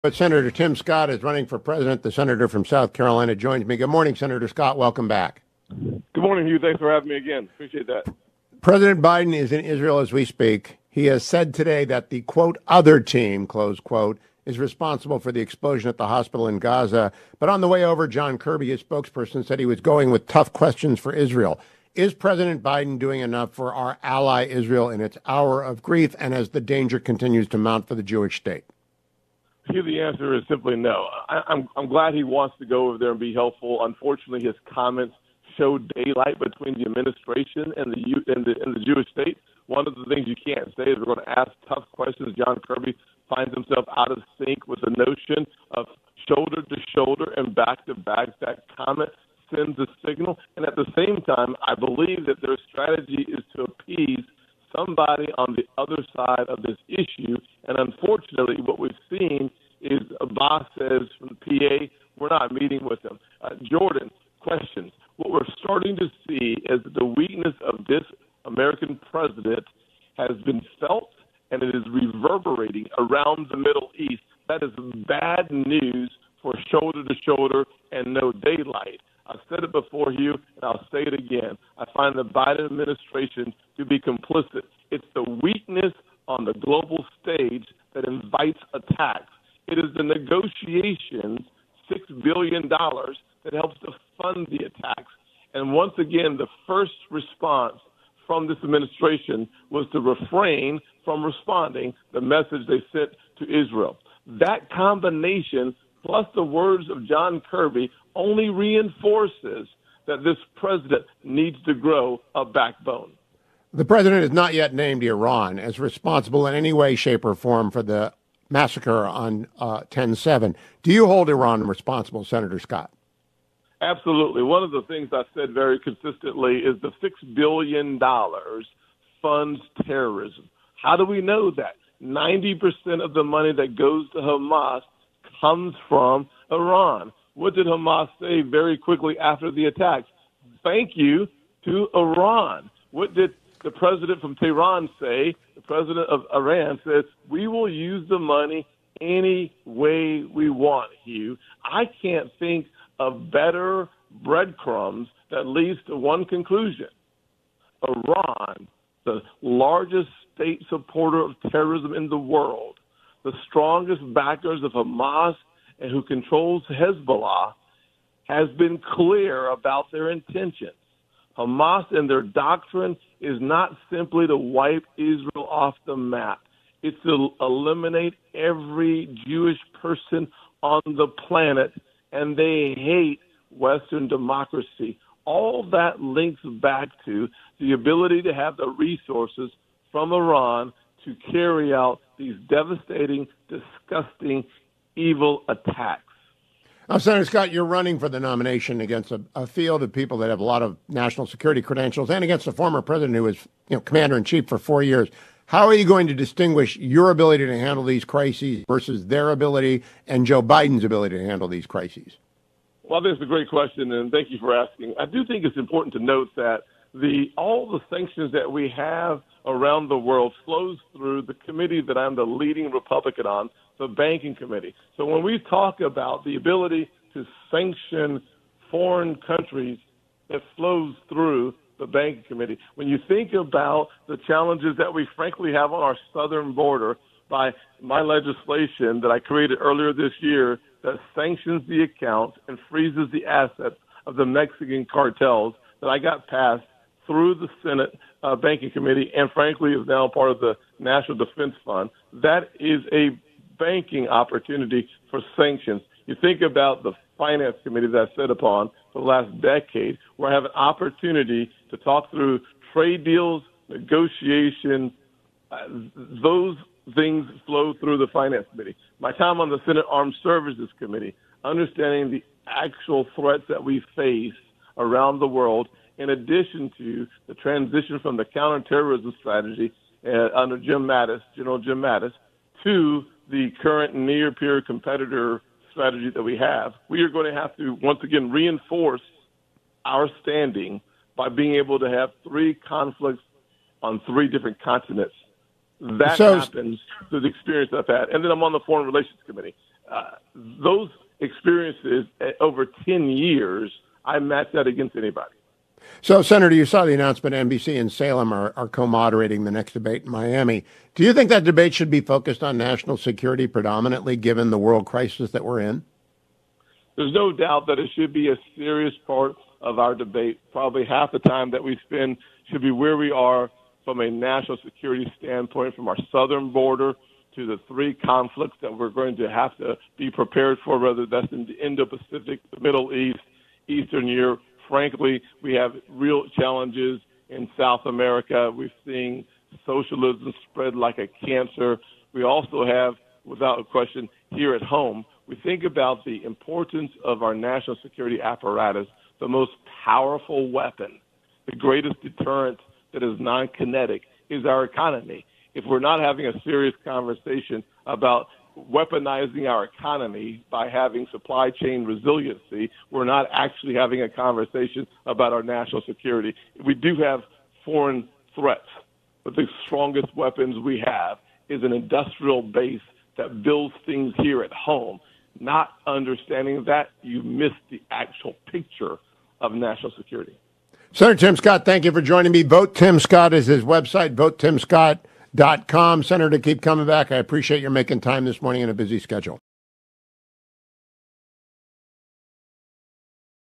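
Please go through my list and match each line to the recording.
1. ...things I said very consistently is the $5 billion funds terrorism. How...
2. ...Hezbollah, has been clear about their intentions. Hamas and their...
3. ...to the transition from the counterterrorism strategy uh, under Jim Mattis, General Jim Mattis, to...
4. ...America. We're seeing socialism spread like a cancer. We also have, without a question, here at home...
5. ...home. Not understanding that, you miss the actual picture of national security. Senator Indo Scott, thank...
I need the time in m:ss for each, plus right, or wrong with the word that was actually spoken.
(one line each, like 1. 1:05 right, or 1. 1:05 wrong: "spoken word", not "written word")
1. 2:04 wrong: "6", not "5"
2. 2:46 right
3. 4:36 right
4. 5:37 right
5. 6:14 wrong: "Tim", not "Indo".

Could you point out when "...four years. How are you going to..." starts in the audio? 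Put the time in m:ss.
3:24.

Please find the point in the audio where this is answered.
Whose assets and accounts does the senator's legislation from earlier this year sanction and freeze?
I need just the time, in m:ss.
4:04.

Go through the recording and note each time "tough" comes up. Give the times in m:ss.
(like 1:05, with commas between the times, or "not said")
0:20, 0:41.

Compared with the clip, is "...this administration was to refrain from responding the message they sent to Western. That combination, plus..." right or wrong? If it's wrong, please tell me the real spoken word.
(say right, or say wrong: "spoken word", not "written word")
wrong: "Israel", not "Western".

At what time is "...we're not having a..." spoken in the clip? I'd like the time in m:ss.
5:55.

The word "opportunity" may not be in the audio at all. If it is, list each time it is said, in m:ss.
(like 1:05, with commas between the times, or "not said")
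4:14, 4:20.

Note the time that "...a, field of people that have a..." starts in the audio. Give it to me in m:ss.
3:19.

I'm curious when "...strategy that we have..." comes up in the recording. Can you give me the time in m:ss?
4:45.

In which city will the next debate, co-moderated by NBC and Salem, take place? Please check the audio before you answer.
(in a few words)
Miami.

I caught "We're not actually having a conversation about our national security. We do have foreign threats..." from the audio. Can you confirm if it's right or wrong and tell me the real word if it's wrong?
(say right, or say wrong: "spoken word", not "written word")
right.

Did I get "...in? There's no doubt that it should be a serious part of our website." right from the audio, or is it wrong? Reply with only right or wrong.
wrong.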